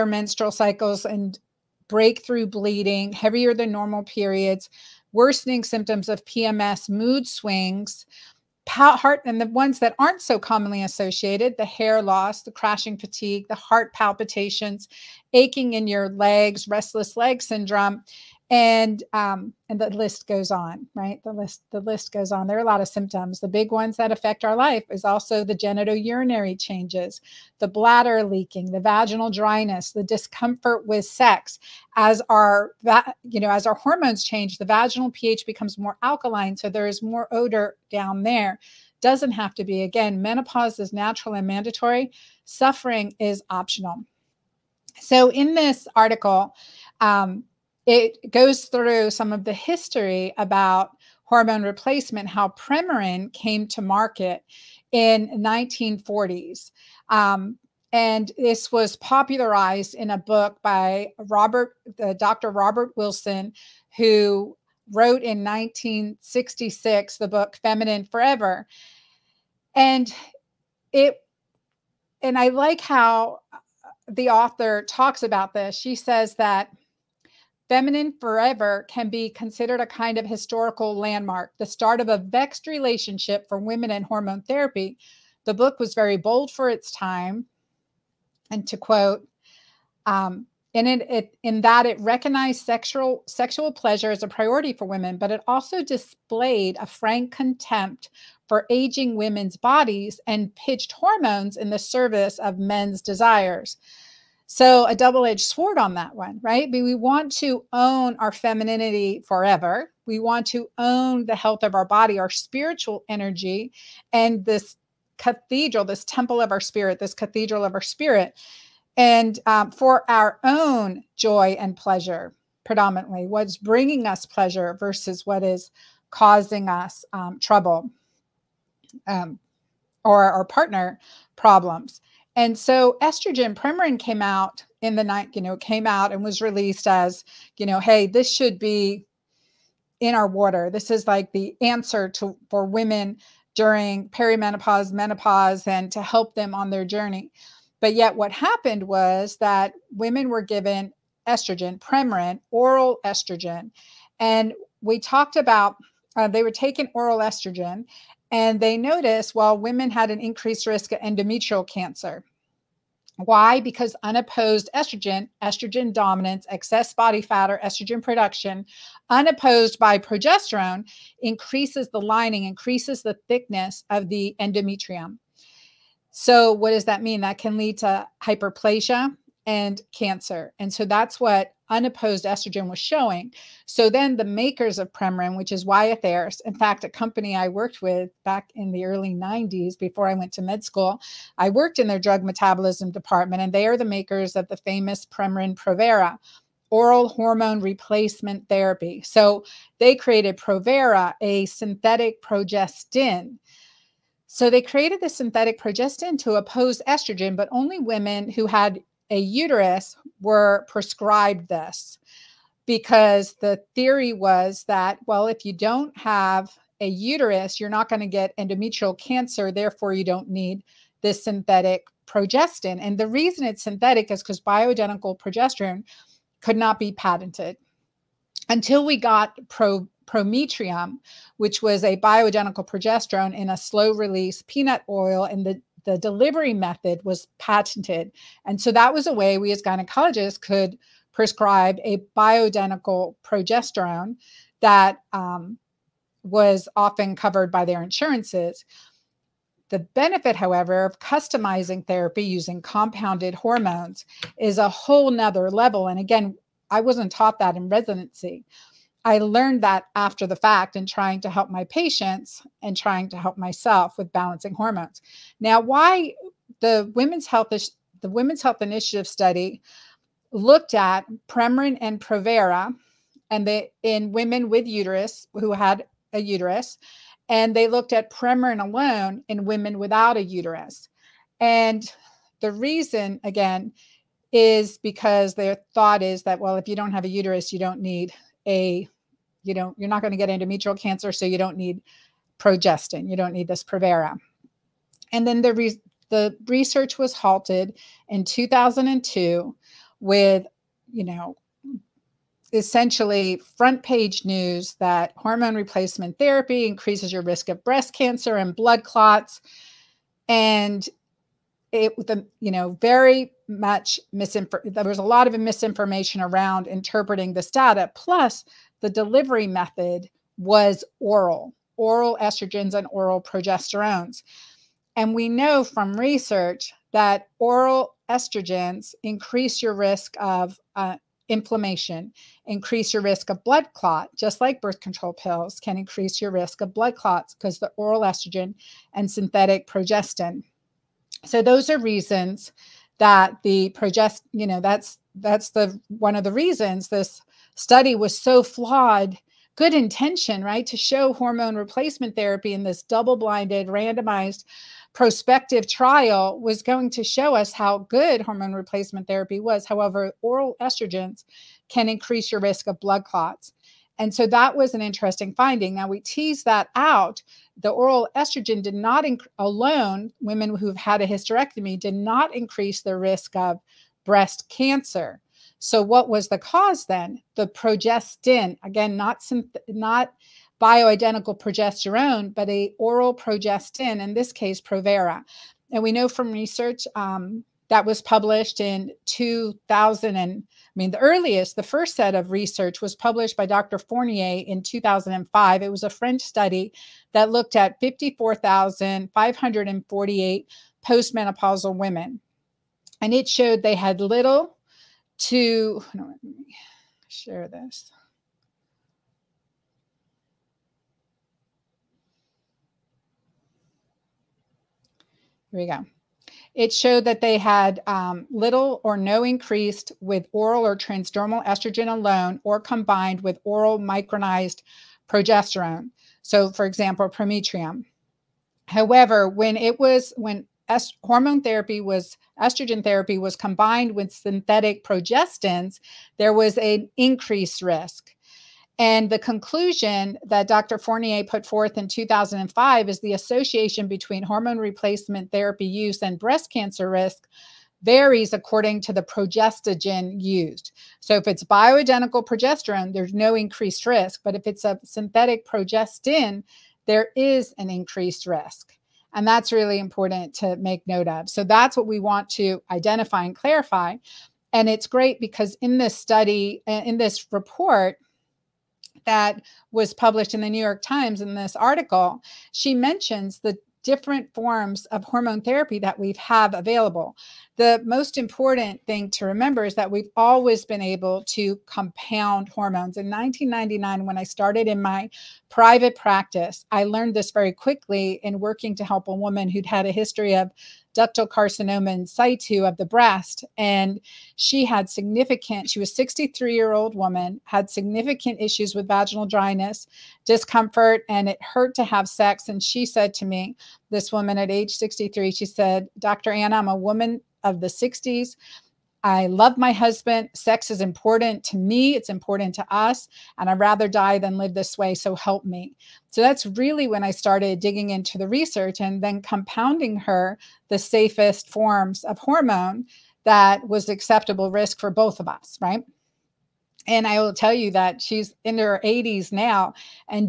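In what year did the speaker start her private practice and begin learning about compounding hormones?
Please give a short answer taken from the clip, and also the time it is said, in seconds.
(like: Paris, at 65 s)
1999, at 483 s.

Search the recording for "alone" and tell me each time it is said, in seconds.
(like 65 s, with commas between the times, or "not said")
278 s, 369 s, 421 s.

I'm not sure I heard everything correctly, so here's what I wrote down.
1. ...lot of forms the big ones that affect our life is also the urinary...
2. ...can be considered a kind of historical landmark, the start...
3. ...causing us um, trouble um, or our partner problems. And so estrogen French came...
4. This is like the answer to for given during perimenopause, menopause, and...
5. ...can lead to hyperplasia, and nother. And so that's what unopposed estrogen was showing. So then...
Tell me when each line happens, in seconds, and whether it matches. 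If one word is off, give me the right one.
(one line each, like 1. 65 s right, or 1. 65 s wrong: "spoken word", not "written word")
1. 22 s wrong: "symptoms", not "forms"
2. 78 s right
3. 126 s wrong: "Premarin", not "French"
4. 140 s wrong: "women", not "given"
5. 177 s wrong: "cancer", not "nother".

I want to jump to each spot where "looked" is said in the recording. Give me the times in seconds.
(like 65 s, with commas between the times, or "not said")
270 s, 277 s, 397 s.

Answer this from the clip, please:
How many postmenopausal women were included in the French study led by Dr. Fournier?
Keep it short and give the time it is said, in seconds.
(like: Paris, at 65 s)
54,548, at 397 s.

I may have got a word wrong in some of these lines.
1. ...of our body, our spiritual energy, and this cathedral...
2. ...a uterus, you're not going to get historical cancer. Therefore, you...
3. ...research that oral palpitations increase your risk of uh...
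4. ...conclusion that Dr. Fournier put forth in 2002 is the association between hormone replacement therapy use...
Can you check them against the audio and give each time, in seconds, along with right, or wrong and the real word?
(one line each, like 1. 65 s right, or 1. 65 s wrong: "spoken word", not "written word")
1. 111 s right
2. 216 s wrong: "endometrial", not "historical"
3. 325 s wrong: "estrogens", not "palpitations"
4. 439 s wrong: "2005", not "2002".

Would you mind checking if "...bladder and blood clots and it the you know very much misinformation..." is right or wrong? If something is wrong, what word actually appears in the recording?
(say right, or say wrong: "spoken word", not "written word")
wrong: "cancer", not "bladder".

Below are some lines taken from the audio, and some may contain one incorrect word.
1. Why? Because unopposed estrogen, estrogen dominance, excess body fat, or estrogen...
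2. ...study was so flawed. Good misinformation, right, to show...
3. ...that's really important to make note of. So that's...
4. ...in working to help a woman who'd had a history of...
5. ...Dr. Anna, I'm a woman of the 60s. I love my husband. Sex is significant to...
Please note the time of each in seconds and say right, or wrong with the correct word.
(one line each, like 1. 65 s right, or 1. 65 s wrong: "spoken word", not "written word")
1. 163 s right
2. 347 s wrong: "intention", not "misinformation"
3. 459 s right
4. 488 s right
5. 505 s wrong: "important", not "significant".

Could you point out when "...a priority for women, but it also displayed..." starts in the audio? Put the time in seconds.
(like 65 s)
94 s.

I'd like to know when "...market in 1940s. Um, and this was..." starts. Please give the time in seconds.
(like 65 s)
53 s.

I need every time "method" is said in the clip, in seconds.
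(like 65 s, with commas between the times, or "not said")
236 s, 319 s.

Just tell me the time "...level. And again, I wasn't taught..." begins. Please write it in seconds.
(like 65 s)
255 s.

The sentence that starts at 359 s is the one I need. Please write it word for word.
However, oral estrogens can increase your risk of blood clots.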